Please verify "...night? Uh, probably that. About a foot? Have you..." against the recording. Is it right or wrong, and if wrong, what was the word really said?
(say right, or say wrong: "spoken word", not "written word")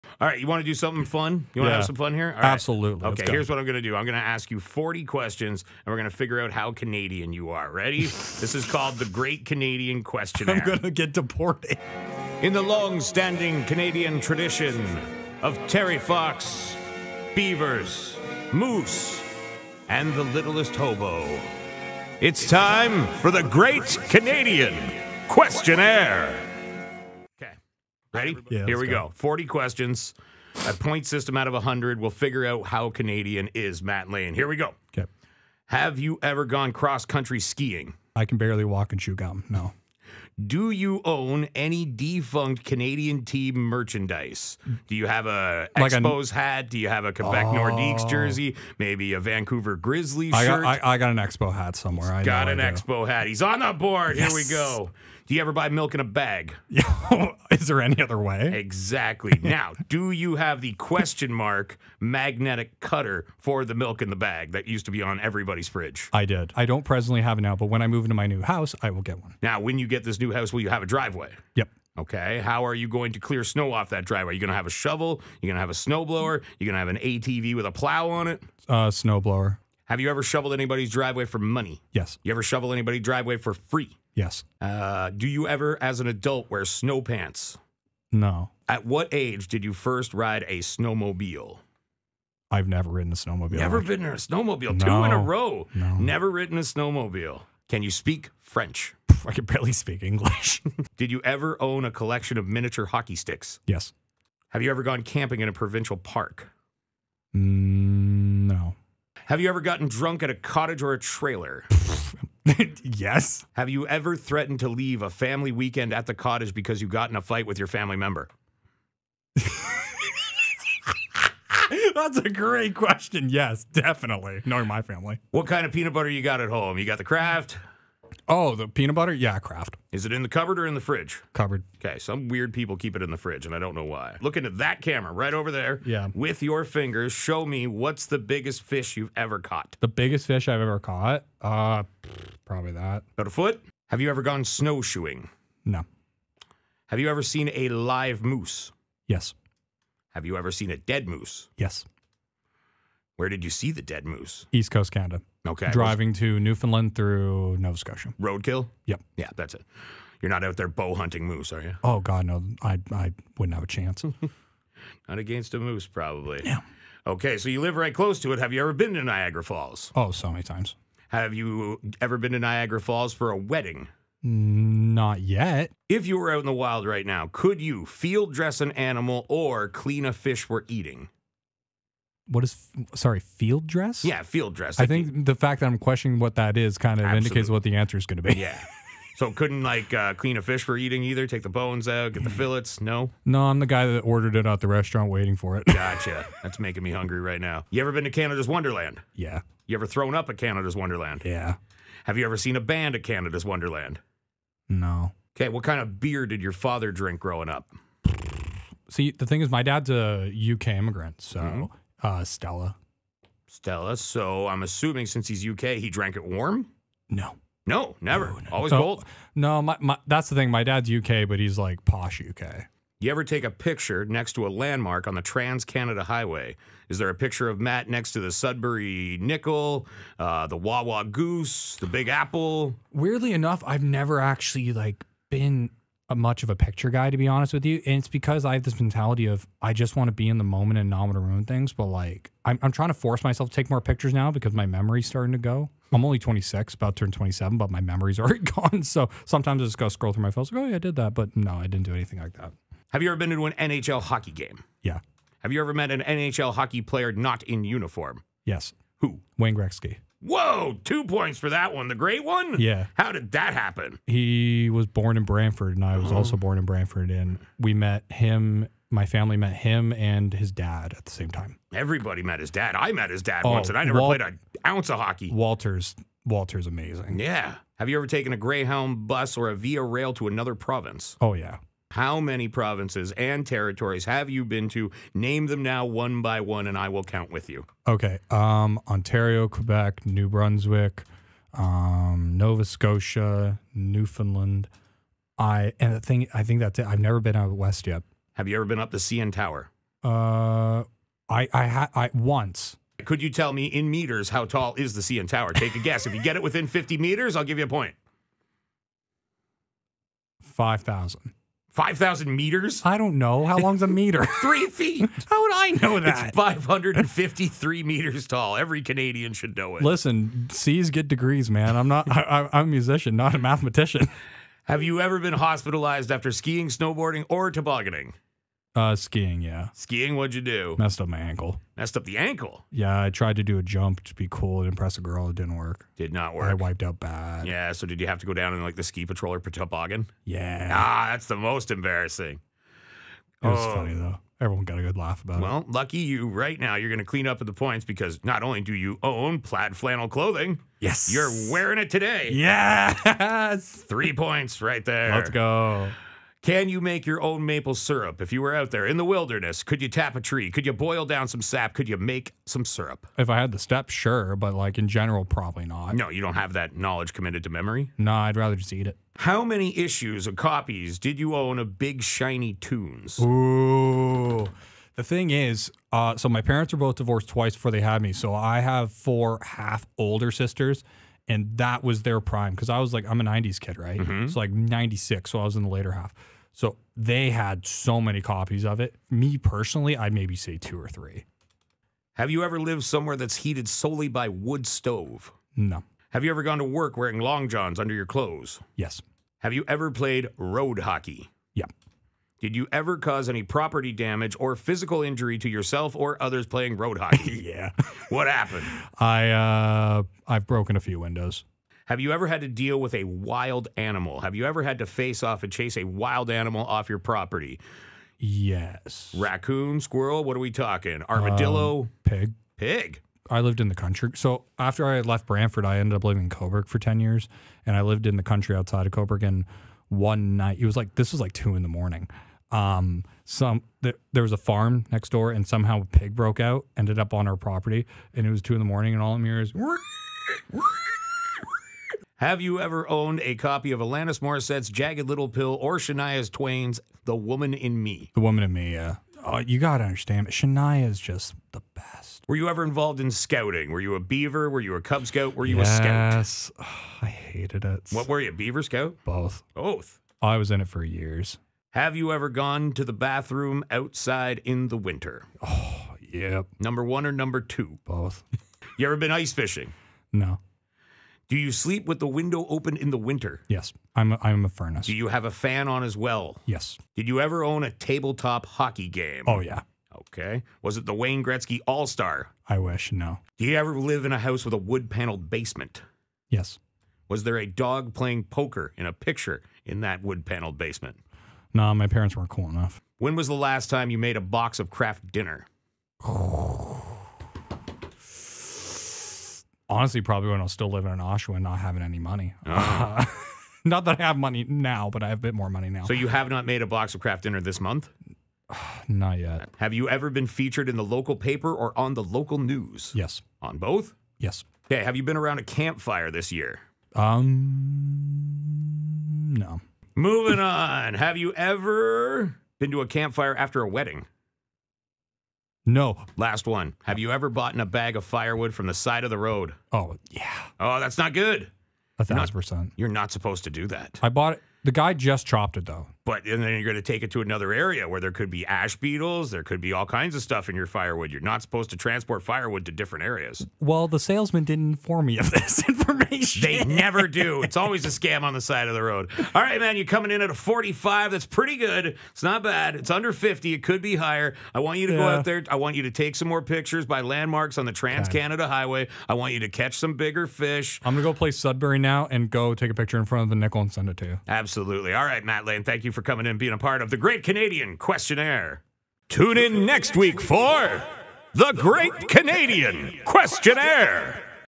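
wrong: "caught", not "night".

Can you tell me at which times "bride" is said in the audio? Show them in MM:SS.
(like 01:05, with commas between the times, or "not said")
not said.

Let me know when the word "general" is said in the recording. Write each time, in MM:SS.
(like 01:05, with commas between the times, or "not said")
06:04.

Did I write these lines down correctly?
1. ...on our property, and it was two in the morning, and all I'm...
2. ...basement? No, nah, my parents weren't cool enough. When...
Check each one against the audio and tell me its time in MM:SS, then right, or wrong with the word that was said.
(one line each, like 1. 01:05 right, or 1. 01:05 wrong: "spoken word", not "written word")
1. 07:17 right
2. 08:10 right.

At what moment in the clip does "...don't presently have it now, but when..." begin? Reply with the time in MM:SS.
01:06.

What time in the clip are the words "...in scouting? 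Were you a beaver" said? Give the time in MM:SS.
07:33.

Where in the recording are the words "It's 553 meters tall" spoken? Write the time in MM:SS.
05:16.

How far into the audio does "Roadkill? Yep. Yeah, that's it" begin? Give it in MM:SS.
02:38.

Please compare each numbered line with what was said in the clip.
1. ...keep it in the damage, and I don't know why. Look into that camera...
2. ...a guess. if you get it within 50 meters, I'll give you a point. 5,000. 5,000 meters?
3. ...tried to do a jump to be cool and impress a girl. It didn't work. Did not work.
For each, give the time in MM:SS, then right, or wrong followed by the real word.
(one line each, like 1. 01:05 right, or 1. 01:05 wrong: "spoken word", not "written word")
1. 02:12 wrong: "fridge", not "damage"
2. 05:05 right
3. 05:33 right.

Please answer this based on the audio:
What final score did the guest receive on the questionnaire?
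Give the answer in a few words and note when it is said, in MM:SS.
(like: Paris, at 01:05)
45, at 09:09.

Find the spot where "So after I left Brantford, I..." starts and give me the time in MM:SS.
07:04.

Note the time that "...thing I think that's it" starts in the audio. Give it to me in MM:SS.
04:55.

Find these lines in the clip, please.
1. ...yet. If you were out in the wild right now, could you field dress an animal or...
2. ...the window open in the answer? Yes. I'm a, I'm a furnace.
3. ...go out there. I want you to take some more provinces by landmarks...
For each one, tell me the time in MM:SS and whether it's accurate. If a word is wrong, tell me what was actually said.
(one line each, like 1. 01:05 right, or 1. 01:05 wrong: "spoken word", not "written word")
1. 02:55 right
2. 07:51 wrong: "winter", not "answer"
3. 09:14 wrong: "pictures", not "provinces".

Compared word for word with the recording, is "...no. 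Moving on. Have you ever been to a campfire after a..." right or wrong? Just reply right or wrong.
right.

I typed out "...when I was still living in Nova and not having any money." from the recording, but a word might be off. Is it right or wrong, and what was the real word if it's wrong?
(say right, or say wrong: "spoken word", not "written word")
wrong: "Oshawa", not "Nova".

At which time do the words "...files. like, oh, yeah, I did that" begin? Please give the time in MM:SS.
04:10.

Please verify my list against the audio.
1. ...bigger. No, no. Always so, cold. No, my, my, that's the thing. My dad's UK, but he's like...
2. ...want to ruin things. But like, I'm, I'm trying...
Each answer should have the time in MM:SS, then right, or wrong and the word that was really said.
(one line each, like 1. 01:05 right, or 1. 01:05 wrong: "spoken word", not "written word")
1. 03:38 wrong: "never", not "bigger"
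2. 04:01 right.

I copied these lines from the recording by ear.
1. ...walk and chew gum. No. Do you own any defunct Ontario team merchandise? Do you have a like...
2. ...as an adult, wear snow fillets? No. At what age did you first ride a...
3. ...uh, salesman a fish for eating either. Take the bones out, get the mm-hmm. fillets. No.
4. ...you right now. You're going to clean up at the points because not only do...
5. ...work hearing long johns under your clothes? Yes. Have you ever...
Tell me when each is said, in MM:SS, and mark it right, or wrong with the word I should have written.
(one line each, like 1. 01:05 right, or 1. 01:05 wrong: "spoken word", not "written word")
1. 00:38 wrong: "Canadian", not "Ontario"
2. 01:25 wrong: "pants", not "fillets"
3. 03:09 wrong: "clean", not "salesman"
4. 05:45 right
5. 06:36 wrong: "wearing", not "hearing".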